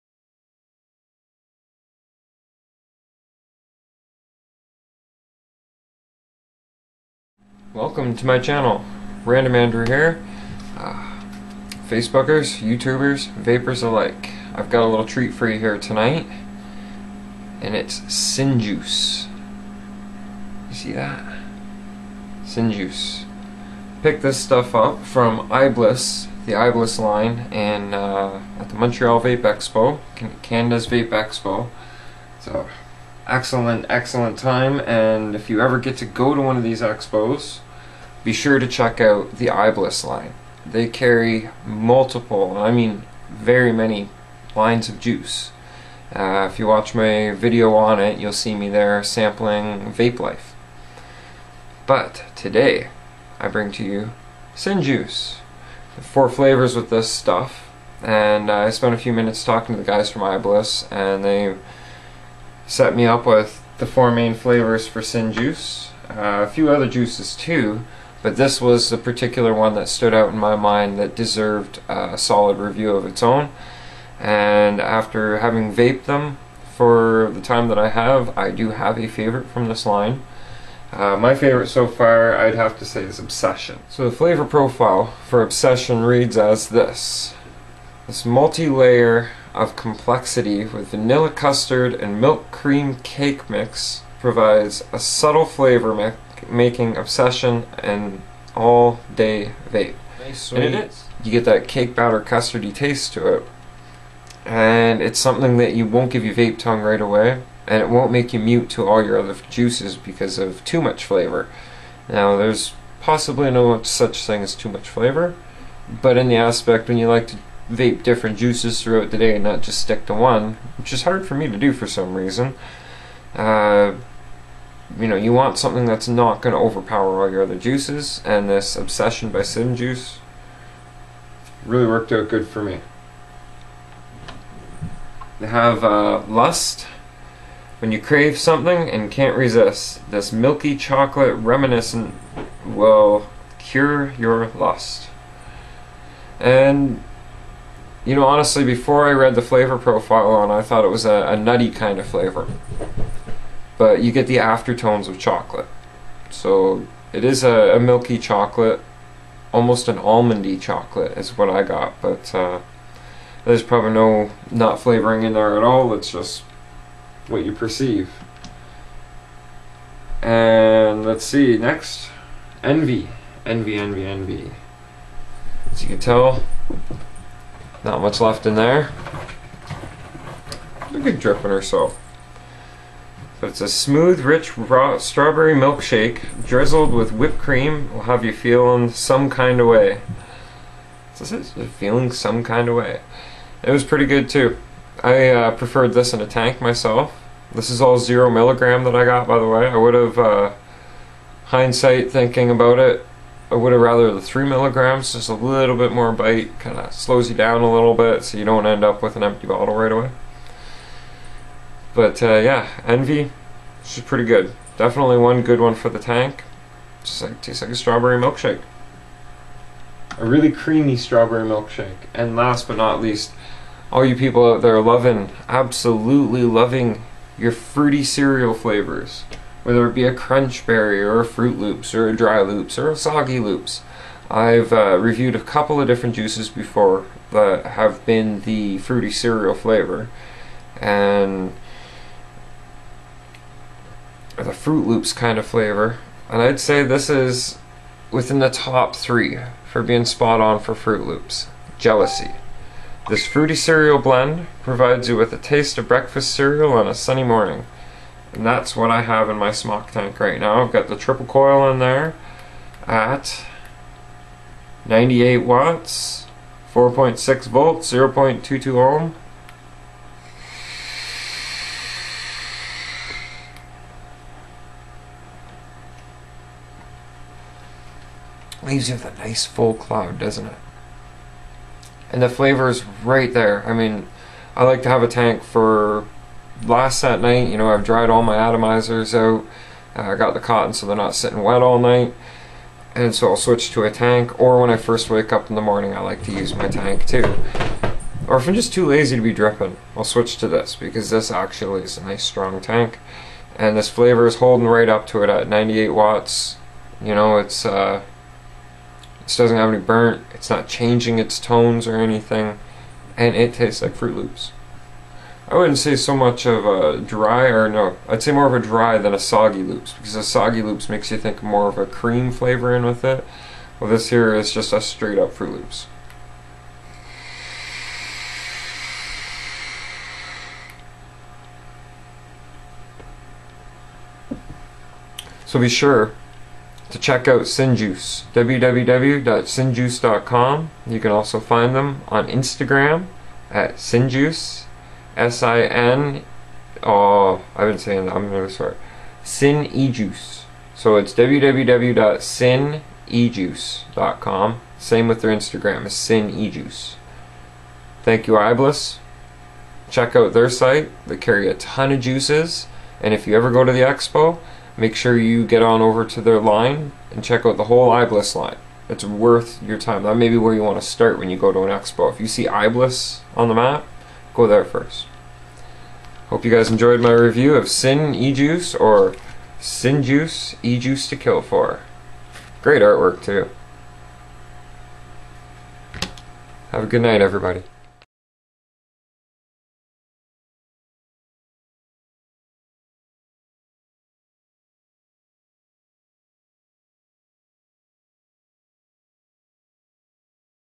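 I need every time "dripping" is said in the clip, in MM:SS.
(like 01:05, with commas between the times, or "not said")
03:01, 04:59.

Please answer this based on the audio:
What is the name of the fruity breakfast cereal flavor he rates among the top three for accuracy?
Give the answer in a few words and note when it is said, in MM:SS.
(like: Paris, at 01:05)
Jealousy, at 04:11.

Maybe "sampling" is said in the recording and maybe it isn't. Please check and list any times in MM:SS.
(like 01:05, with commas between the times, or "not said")
00:49.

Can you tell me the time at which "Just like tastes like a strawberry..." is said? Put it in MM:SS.
03:37.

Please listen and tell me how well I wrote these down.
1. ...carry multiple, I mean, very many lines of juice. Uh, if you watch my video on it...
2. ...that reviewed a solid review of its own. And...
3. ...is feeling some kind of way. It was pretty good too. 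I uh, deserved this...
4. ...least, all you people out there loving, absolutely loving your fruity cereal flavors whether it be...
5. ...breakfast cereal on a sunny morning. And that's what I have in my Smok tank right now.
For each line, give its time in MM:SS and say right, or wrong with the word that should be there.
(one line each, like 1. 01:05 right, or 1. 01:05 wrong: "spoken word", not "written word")
1. 00:40 right
2. 01:10 wrong: "deserved", not "reviewed"
3. 03:11 wrong: "preferred", not "deserved"
4. 03:43 right
5. 04:15 right.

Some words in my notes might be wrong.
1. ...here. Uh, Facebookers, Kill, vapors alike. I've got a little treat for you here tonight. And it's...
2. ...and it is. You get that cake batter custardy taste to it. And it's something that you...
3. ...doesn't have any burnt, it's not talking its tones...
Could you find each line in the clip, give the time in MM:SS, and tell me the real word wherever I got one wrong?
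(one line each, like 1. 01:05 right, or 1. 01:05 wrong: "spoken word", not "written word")
1. 00:09 wrong: "YouTubers", not "Kill"
2. 01:40 right
3. 05:09 wrong: "changing", not "talking".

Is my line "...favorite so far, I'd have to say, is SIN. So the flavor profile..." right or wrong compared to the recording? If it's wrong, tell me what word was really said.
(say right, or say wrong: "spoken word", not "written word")
wrong: "Obsession", not "SIN".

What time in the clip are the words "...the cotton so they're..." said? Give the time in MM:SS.
04:50.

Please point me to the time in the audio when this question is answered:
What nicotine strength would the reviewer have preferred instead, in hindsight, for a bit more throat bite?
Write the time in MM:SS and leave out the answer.
03:24.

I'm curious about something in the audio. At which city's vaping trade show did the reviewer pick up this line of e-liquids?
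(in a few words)
Montreal.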